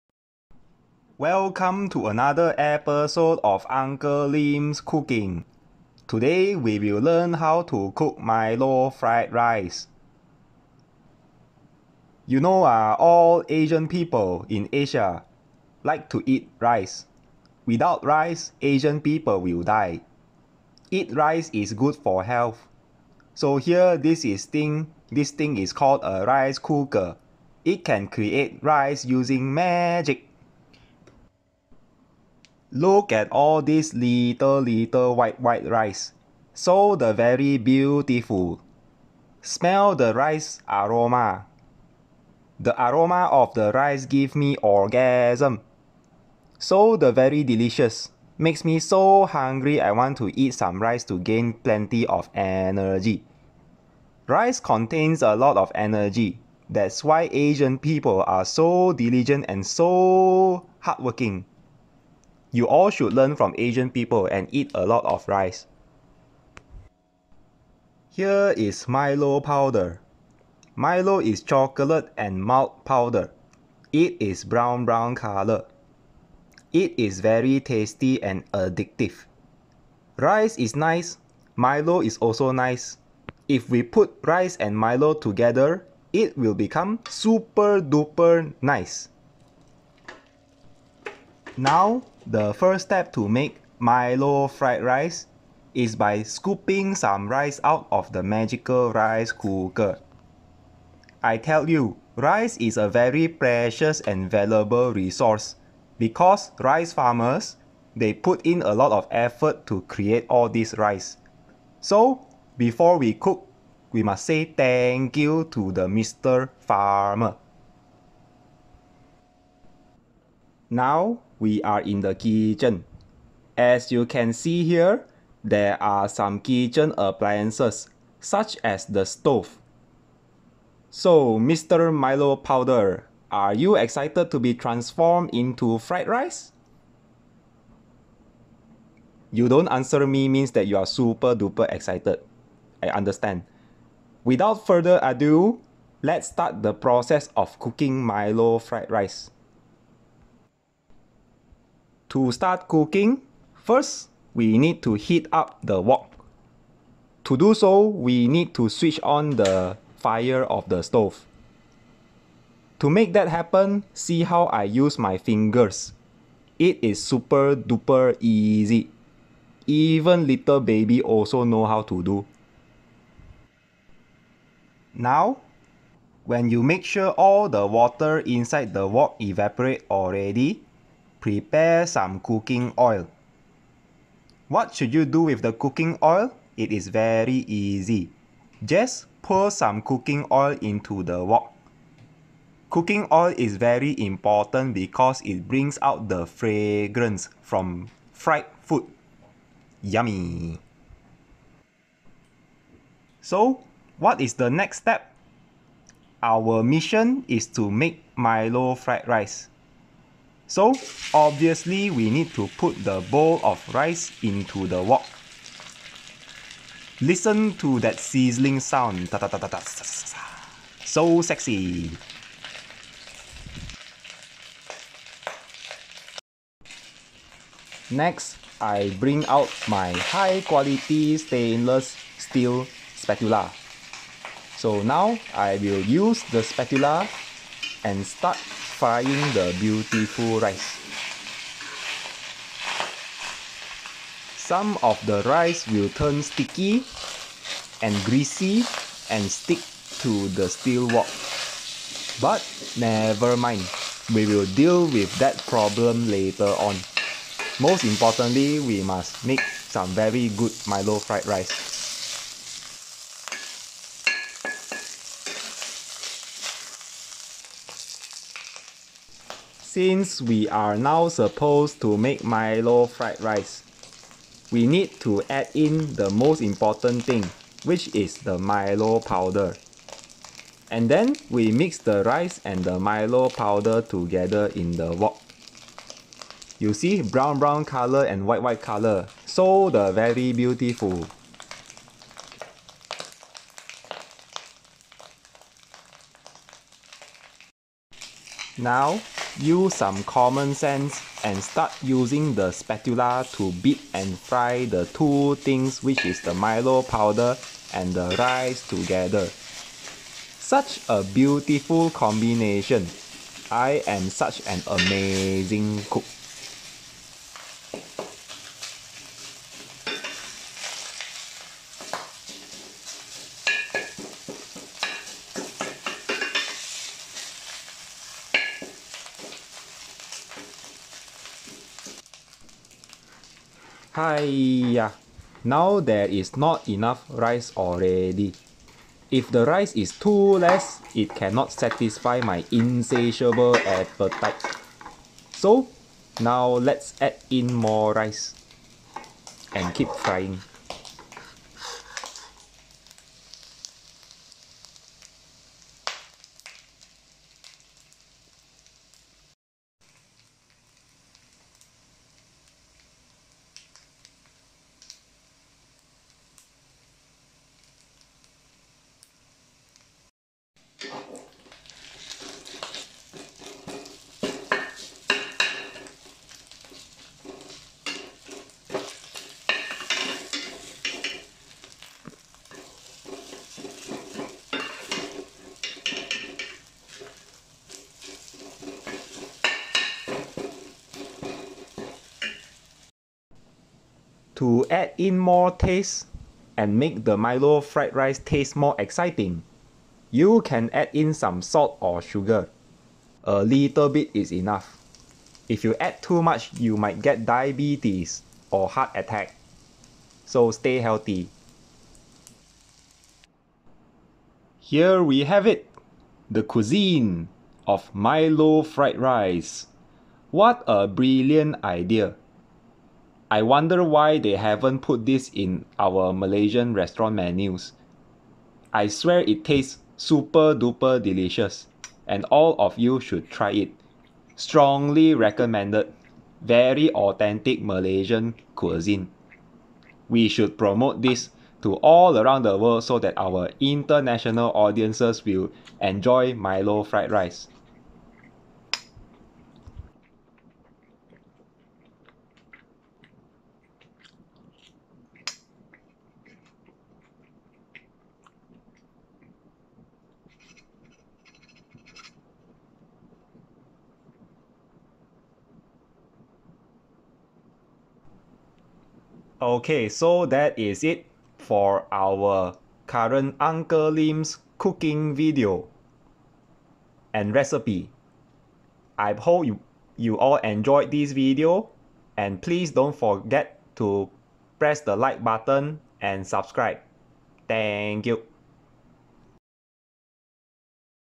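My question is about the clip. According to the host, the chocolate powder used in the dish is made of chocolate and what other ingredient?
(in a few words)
malt.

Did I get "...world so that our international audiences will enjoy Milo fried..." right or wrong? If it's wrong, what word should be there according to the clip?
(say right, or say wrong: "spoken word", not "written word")
right.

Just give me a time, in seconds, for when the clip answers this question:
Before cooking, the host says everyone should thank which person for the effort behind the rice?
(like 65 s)
115 s.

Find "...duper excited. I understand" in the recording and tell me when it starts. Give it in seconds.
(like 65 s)
141 s.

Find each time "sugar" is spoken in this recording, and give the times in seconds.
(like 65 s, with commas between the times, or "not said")
402 s.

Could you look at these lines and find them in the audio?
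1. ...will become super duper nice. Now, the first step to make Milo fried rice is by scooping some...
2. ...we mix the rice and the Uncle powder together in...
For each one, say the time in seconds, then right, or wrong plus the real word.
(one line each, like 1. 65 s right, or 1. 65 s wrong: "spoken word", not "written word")
1. 86 s right
2. 281 s wrong: "Milo", not "Uncle".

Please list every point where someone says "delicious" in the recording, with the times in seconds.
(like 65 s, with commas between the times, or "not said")
47 s, 431 s.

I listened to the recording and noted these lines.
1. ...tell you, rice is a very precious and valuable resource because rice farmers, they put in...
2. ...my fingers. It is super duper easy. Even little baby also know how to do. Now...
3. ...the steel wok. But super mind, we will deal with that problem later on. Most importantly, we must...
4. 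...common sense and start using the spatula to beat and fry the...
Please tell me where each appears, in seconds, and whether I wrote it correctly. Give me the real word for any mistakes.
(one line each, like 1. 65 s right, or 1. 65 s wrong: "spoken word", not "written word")
1. 101 s right
2. 164 s right
3. 250 s wrong: "never", not "super"
4. 300 s right.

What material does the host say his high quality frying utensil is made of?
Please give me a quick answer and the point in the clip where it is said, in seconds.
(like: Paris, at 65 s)
stainless steel, at 231 s.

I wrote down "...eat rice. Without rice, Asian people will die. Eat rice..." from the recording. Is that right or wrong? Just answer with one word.
right.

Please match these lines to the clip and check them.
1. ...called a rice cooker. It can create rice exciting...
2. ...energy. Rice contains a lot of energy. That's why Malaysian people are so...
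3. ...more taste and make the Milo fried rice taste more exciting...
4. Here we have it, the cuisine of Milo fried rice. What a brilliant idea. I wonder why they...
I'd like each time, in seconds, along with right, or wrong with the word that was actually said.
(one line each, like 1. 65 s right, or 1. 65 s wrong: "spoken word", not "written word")
1. 25 s wrong: "using", not "exciting"
2. 52 s wrong: "Asian", not "Malaysian"
3. 395 s right
4. 414 s right.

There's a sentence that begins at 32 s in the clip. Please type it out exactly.
Look at all this little little white white rice.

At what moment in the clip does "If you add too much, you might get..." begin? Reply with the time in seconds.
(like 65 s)
405 s.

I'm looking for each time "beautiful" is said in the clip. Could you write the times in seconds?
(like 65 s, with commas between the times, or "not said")
37 s, 239 s, 290 s, 311 s.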